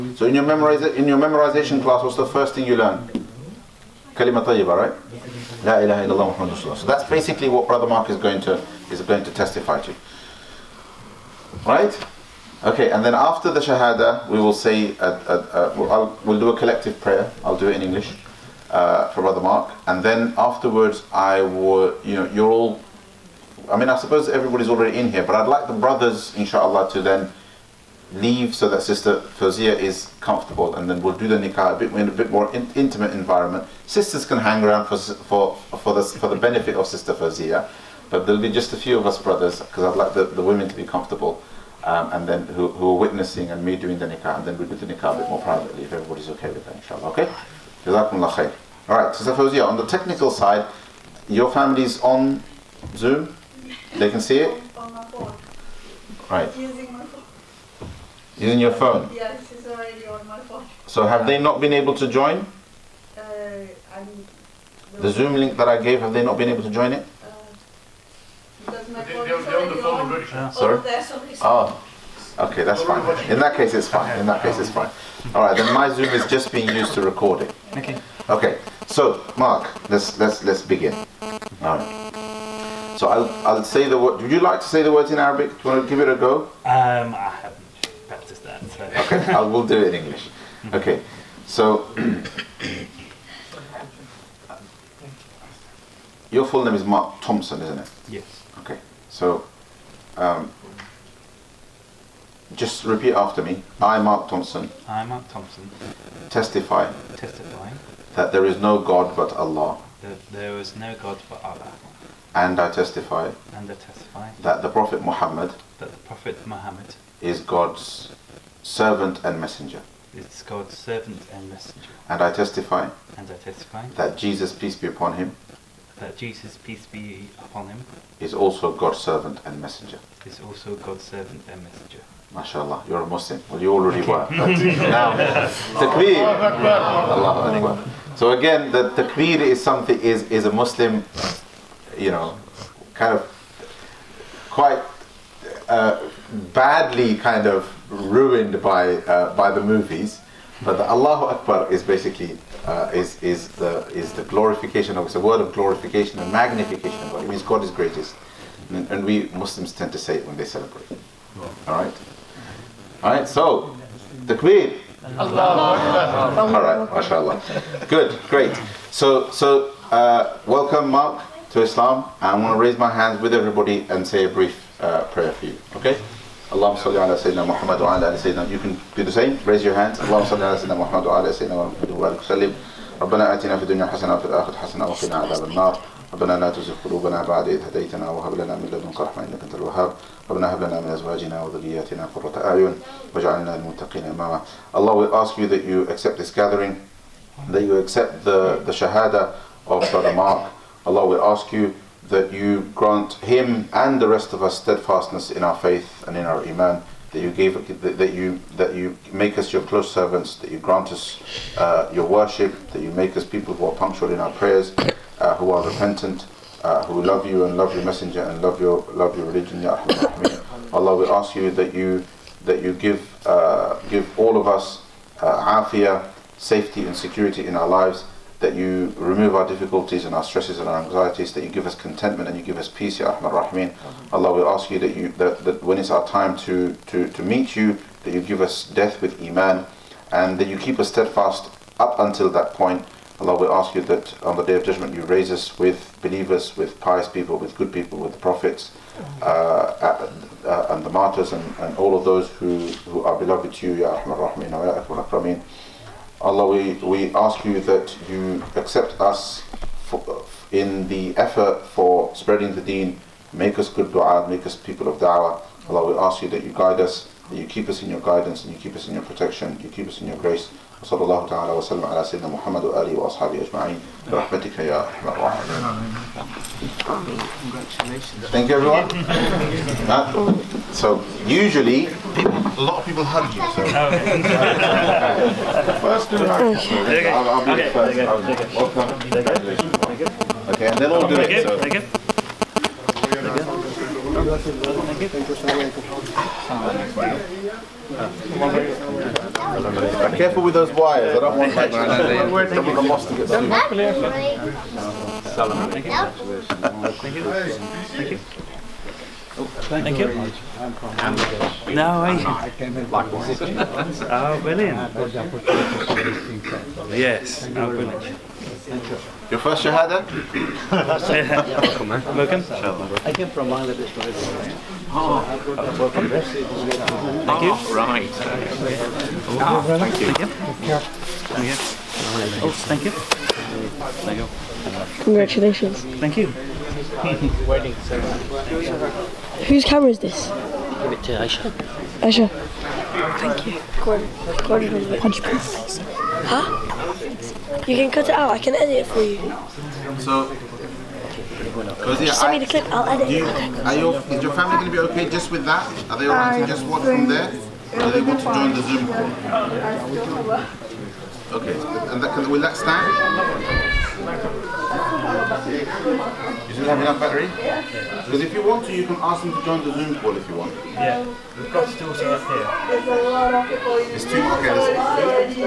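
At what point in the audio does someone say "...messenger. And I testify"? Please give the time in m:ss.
2:01.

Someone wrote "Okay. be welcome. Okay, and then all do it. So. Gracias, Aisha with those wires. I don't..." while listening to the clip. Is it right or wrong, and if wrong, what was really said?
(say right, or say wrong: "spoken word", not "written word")
wrong: "Careful", not "Aisha".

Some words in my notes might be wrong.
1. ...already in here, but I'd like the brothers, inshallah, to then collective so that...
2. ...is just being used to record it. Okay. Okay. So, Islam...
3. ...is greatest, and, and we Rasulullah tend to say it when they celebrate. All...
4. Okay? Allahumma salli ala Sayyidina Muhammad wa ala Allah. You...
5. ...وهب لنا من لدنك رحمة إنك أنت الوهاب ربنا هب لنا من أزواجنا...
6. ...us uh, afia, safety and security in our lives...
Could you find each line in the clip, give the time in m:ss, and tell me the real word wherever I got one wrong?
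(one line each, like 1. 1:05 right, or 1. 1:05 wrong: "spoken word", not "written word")
1. 0:24 wrong: "leave", not "collective"
2. 1:16 wrong: "Mark", not "Islam"
3. 2:37 wrong: "Muslims", not "Rasulullah"
4. 2:55 wrong: "Sayyidina", not "Allah"
5. 3:08 right
6. 3:44 right.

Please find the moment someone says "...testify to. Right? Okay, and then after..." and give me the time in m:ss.
0:09.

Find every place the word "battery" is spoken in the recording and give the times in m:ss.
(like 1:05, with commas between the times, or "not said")
6:07.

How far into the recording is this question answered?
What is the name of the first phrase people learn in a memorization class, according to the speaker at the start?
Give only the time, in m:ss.
0:04.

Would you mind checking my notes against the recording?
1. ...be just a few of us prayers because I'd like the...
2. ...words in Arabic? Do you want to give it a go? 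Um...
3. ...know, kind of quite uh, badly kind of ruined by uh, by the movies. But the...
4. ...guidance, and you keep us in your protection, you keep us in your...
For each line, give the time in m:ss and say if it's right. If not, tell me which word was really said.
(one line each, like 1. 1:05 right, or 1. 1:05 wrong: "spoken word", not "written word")
1. 0:38 wrong: "brothers", not "prayers"
2. 1:24 right
3. 2:22 right
4. 4:28 right.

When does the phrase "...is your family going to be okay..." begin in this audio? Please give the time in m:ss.
5:54.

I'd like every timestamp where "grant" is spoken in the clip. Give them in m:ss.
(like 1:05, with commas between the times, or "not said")
3:22, 3:30.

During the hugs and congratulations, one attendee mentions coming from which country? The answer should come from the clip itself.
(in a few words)
Bangladesh.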